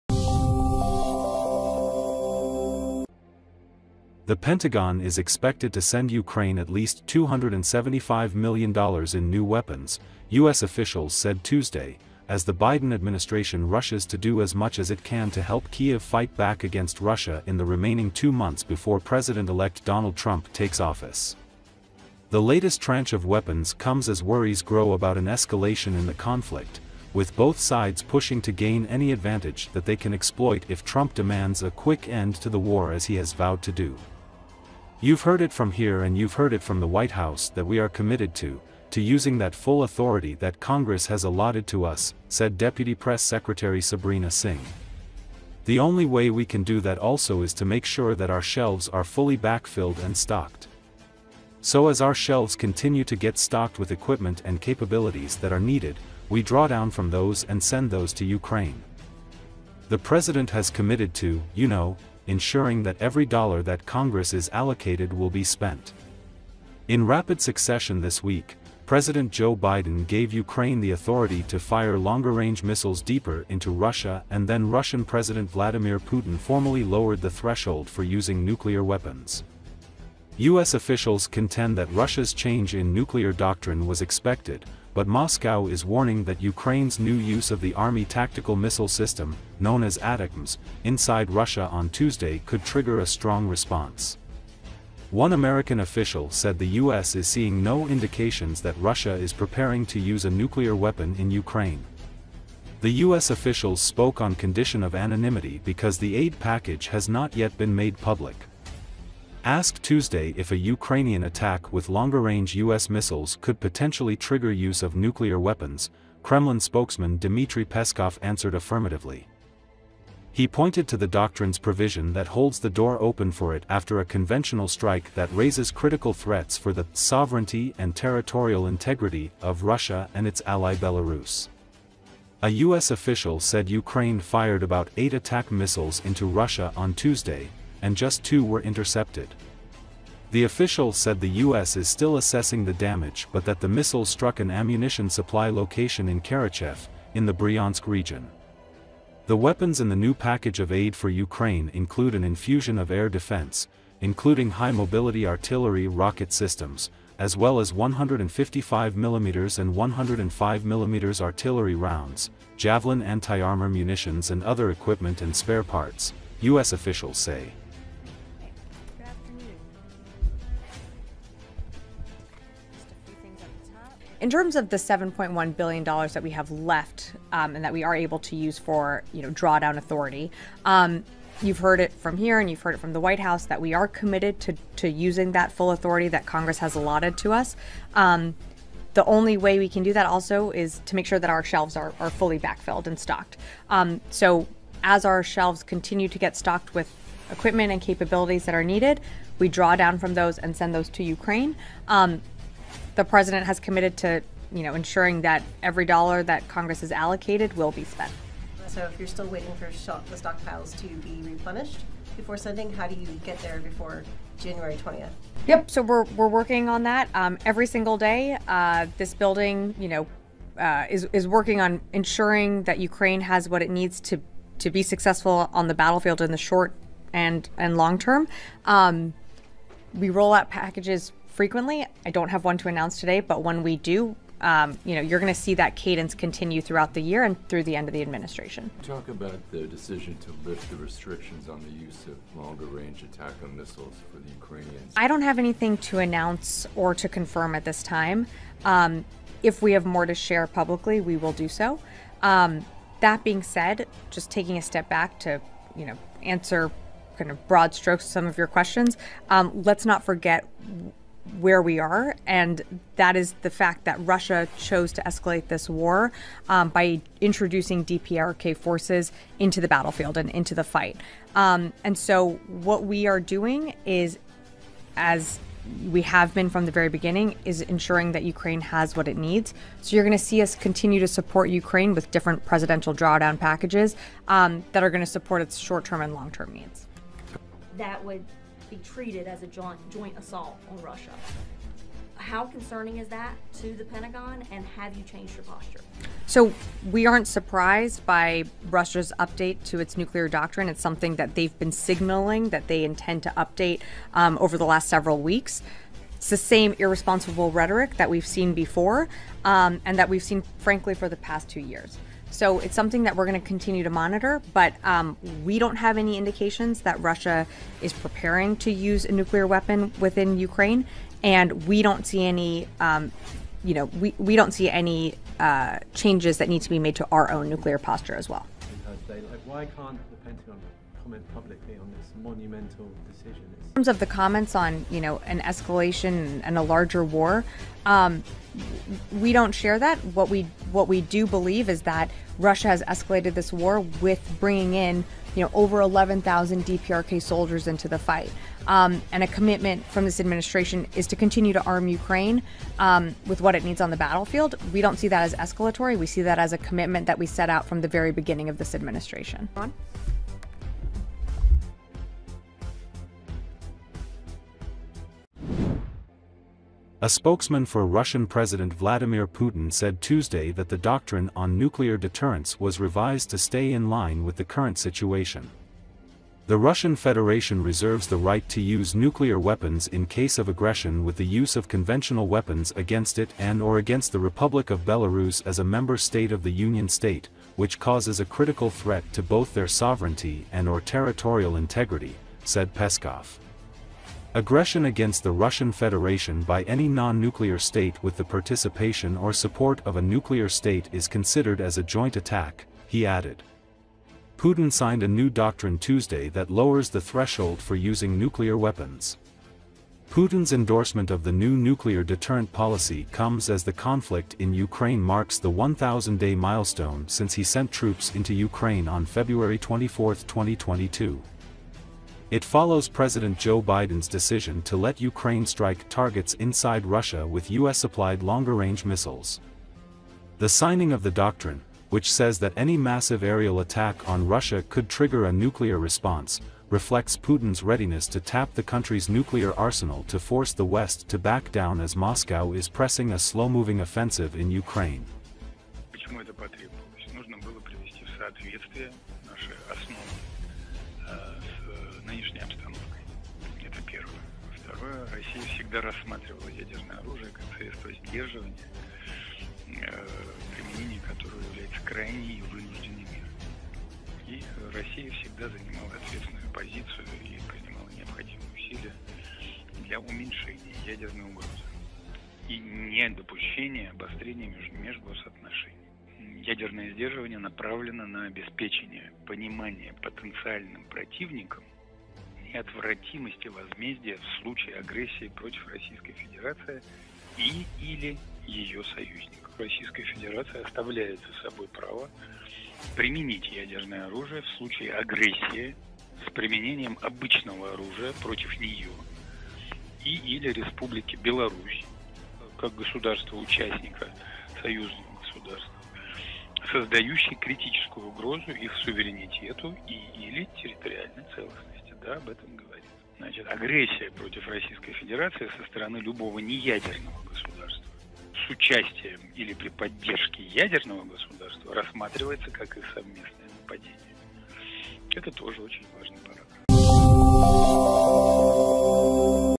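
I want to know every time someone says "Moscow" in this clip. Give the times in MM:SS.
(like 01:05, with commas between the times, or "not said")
01:25, 07:21.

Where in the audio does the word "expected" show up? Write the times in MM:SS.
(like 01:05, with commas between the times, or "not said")
00:05, 01:24.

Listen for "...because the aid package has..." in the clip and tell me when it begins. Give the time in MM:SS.
01:45.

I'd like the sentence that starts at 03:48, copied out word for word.
Um, we roll out packages frequently.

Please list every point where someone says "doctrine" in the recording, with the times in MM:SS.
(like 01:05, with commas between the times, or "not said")
01:23, 02:01, 05:00, 06:10, 06:45, 07:11.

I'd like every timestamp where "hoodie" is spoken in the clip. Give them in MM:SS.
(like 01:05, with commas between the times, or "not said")
not said.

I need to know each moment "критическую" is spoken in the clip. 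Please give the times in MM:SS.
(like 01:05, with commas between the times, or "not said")
08:27.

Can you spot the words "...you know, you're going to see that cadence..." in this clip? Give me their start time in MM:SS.
03:54.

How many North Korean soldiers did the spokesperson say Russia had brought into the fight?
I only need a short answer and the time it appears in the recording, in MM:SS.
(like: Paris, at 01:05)
over 11,000, at 05:45.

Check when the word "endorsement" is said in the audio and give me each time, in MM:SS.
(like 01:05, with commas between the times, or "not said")
06:50.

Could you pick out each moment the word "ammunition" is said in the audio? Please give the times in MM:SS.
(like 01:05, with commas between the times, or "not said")
02:24.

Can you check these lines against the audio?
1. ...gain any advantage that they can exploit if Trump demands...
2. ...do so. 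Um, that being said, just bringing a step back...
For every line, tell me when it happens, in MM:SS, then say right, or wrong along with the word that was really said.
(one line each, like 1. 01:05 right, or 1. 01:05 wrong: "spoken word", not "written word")
1. 00:28 right
2. 04:11 wrong: "taking", not "bringing".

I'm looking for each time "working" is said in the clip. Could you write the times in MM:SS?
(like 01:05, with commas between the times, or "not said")
03:36, 03:41.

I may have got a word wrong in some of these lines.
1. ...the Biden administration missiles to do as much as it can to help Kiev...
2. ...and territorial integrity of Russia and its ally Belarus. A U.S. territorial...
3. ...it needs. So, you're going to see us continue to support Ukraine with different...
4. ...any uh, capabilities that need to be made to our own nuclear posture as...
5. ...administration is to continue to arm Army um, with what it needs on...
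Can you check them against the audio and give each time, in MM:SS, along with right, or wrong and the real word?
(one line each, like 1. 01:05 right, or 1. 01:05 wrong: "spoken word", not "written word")
1. 00:12 wrong: "rushes", not "missiles"
2. 02:07 wrong: "official", not "territorial"
3. 04:39 right
4. 05:24 wrong: "changes", not "capabilities"
5. 05:50 wrong: "Ukraine", not "Army".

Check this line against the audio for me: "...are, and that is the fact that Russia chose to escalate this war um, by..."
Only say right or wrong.
right.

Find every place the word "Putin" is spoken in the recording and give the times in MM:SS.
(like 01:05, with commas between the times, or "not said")
01:15, 06:09, 06:44, 06:50, 07:17.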